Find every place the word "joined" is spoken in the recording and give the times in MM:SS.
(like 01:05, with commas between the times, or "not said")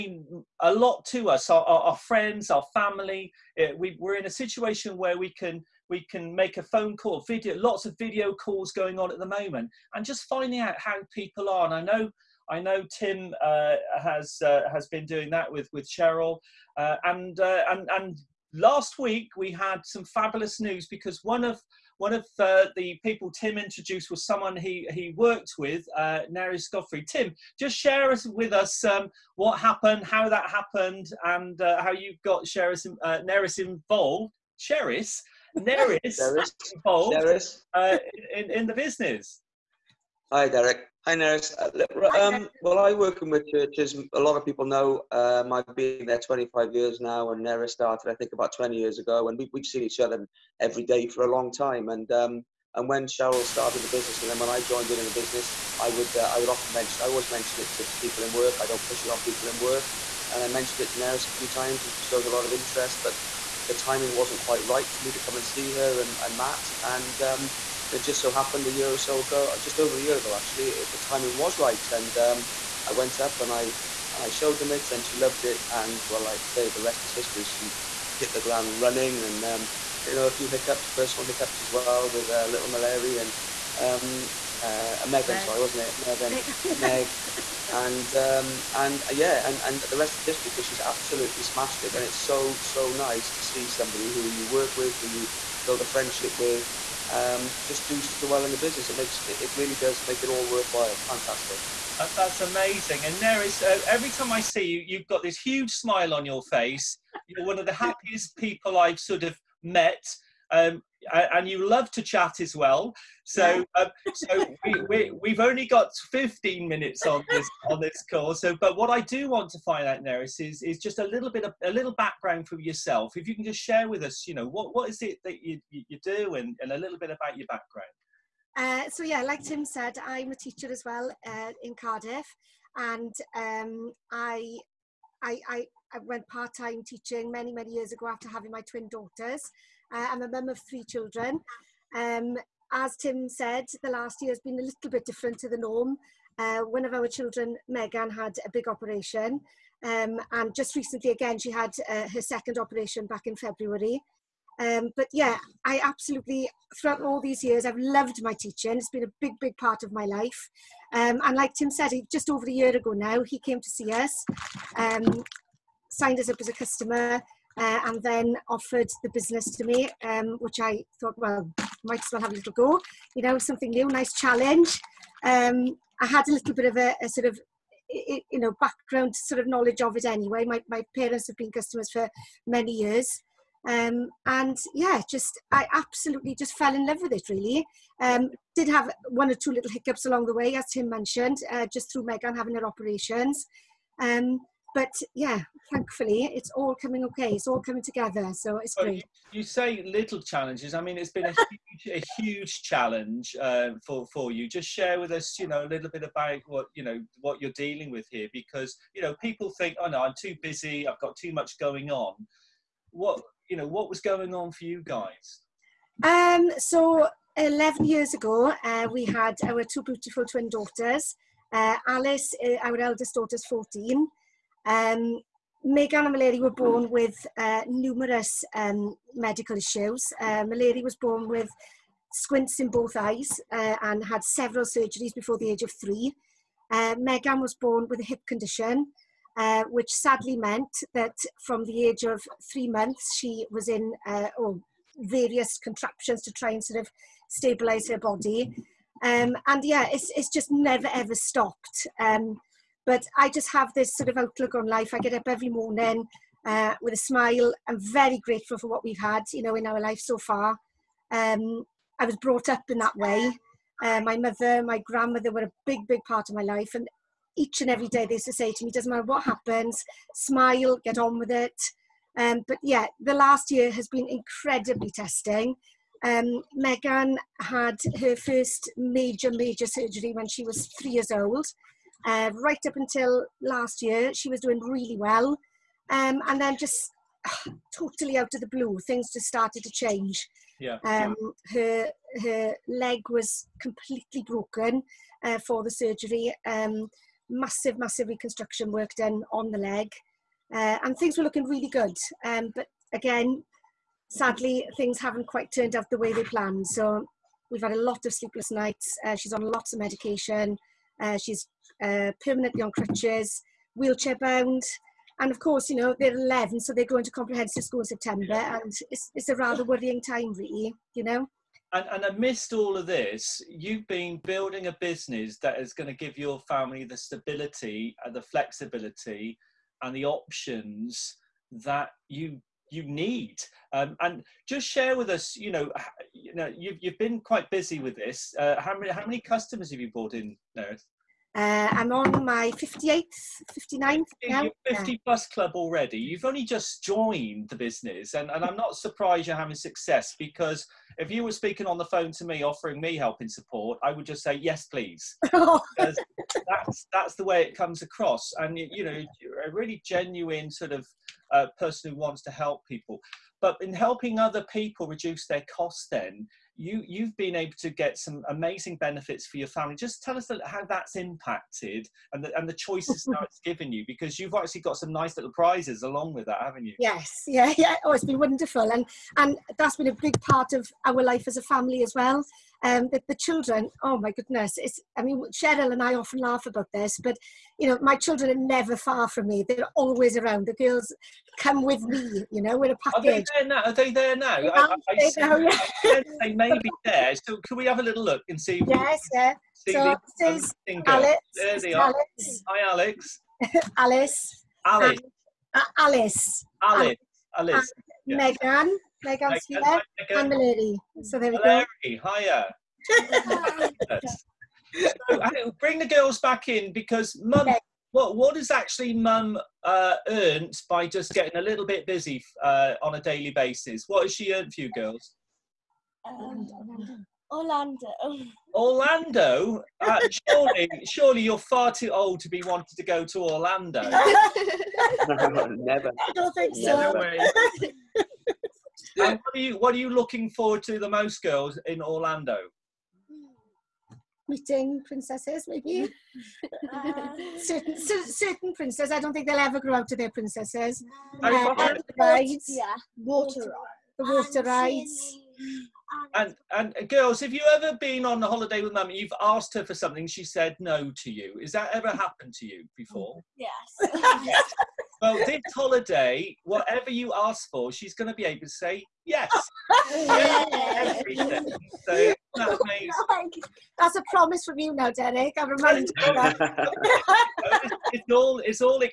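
00:54, 05:46.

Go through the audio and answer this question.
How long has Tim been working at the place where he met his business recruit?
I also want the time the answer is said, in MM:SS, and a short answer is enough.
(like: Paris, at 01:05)
25 years, at 00:46.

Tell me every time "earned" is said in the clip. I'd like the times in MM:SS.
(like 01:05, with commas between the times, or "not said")
07:00, 07:04.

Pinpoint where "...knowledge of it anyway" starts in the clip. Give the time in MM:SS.
02:59.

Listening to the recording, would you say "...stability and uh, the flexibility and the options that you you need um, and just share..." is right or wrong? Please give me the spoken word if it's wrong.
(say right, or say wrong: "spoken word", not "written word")
right.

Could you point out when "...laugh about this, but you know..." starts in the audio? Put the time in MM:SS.
06:26.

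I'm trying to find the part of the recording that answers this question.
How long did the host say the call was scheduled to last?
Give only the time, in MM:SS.
01:56.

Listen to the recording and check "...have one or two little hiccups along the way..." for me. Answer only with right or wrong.
right.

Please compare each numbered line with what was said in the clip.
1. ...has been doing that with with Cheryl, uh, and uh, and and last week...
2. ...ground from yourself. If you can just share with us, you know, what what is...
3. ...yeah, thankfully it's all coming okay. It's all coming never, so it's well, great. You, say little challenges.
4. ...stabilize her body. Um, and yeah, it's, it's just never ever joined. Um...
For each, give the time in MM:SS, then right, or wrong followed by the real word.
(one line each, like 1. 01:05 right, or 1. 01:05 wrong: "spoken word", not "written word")
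1. 00:14 right
2. 02:01 wrong: "background", not "ground"
3. 03:15 wrong: "together", not "never"
4. 04:07 wrong: "stopped", not "joined".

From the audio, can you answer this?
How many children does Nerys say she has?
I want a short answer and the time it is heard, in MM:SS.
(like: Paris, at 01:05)
3, at 02:20.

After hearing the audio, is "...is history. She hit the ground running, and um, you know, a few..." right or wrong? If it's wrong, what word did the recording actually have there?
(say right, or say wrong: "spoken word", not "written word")
right.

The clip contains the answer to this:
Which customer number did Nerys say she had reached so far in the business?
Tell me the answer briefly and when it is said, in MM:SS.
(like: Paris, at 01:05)
58th or 59th, at 05:42.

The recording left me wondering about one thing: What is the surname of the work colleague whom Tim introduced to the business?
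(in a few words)
Godfrey.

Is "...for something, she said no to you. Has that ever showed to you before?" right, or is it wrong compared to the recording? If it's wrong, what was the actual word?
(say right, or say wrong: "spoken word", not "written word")
wrong: "happened", not "showed".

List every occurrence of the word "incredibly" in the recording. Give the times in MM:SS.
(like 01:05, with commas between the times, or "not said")
04:34.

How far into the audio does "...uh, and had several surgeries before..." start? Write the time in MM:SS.
03:53.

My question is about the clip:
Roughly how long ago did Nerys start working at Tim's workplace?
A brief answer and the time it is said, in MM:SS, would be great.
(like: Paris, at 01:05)
20 years ago, at 00:48.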